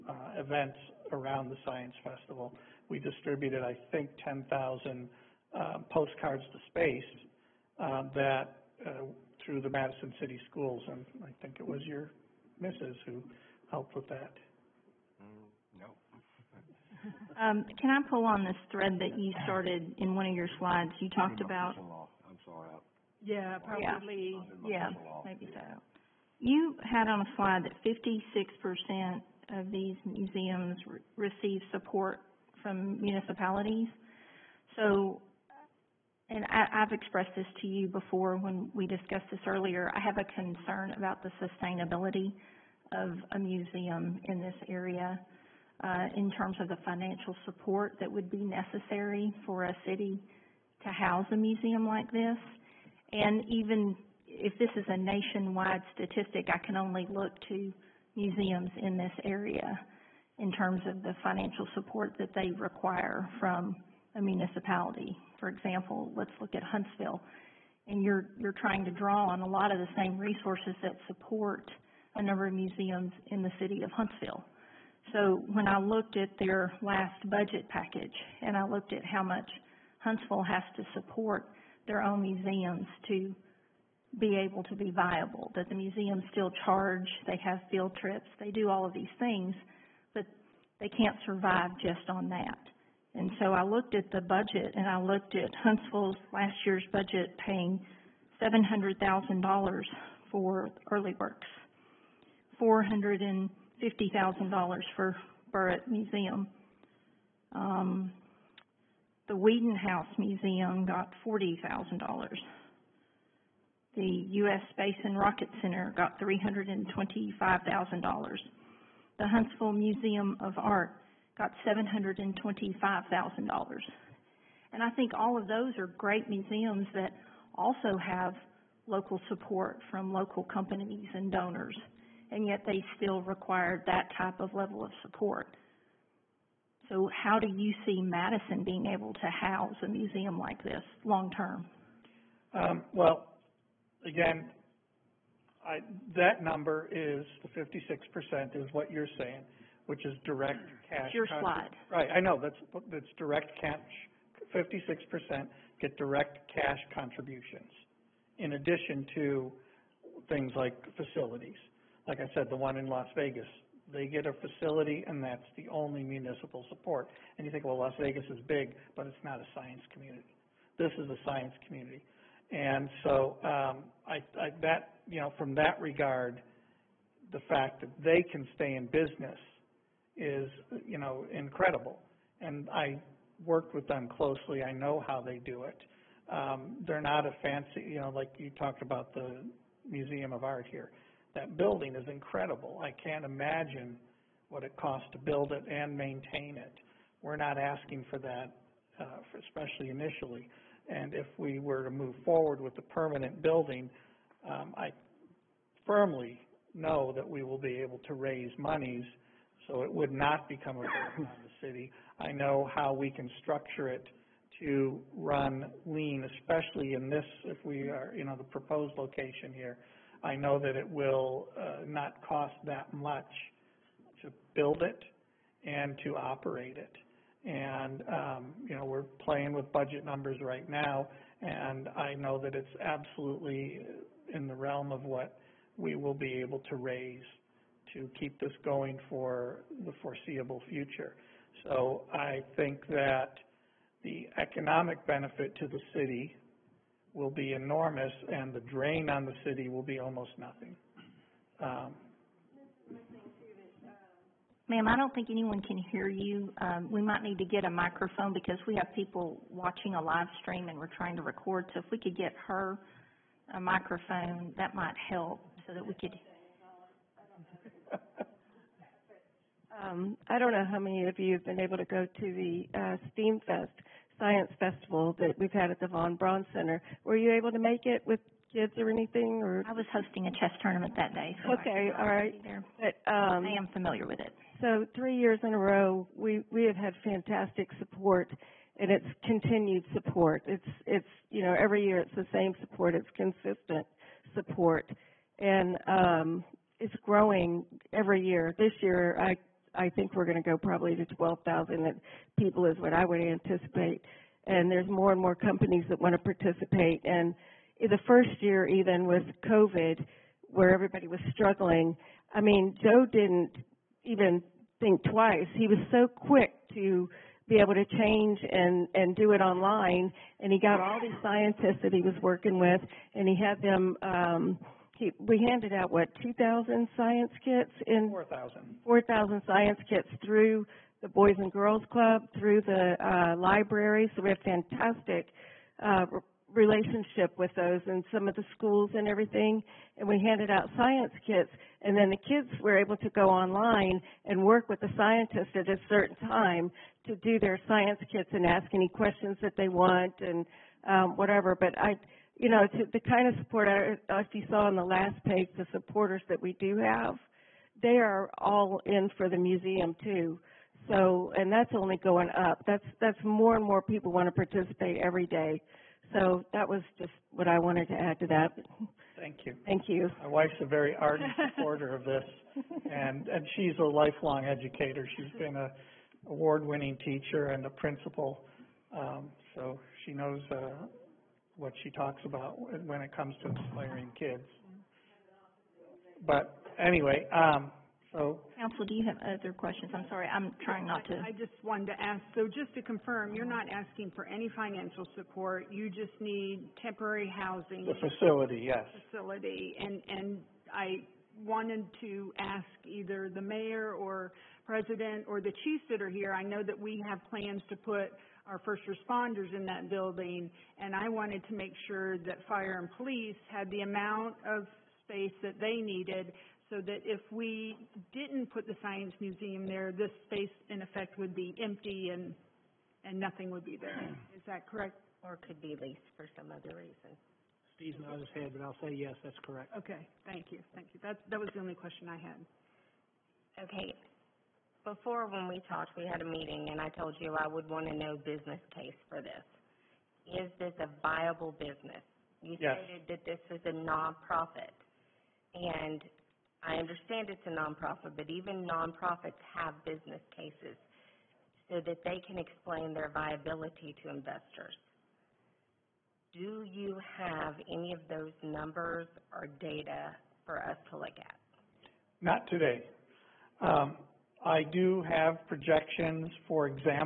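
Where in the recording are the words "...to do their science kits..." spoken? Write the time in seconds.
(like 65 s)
347 s.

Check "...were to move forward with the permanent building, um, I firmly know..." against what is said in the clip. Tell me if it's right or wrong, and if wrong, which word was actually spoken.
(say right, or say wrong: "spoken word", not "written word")
right.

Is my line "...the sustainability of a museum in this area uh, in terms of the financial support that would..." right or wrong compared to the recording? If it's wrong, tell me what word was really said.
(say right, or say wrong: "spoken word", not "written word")
right.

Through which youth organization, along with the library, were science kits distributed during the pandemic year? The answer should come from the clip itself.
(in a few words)
Boys and Girls Club.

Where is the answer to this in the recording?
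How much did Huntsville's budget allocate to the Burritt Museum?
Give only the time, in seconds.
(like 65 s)
102 s.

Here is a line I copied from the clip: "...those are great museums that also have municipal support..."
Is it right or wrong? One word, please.
wrong.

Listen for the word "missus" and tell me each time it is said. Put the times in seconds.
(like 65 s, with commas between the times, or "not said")
12 s.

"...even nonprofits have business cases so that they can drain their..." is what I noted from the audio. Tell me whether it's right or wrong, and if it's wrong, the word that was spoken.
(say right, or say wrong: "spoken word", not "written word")
wrong: "explain", not "drain".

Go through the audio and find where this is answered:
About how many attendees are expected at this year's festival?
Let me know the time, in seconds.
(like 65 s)
301 s.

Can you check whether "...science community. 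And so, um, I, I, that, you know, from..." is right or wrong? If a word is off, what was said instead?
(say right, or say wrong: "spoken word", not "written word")
right.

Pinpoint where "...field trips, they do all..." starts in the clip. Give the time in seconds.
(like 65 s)
87 s.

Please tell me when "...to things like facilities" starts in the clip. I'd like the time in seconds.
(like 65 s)
159 s.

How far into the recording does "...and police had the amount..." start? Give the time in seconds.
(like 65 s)
412 s.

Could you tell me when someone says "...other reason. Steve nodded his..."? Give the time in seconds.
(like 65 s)
426 s.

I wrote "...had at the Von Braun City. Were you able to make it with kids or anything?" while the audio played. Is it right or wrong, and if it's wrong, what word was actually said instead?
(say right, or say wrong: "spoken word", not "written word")
wrong: "Center", not "City".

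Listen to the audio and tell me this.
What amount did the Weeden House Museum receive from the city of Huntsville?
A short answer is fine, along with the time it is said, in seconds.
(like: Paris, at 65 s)
$40,000, at 111 s.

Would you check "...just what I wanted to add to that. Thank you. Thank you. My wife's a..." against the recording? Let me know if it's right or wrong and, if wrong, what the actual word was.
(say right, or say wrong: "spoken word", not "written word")
right.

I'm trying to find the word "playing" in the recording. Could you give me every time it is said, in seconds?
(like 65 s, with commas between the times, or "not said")
229 s.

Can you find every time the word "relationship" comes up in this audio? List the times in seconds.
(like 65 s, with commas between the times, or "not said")
336 s.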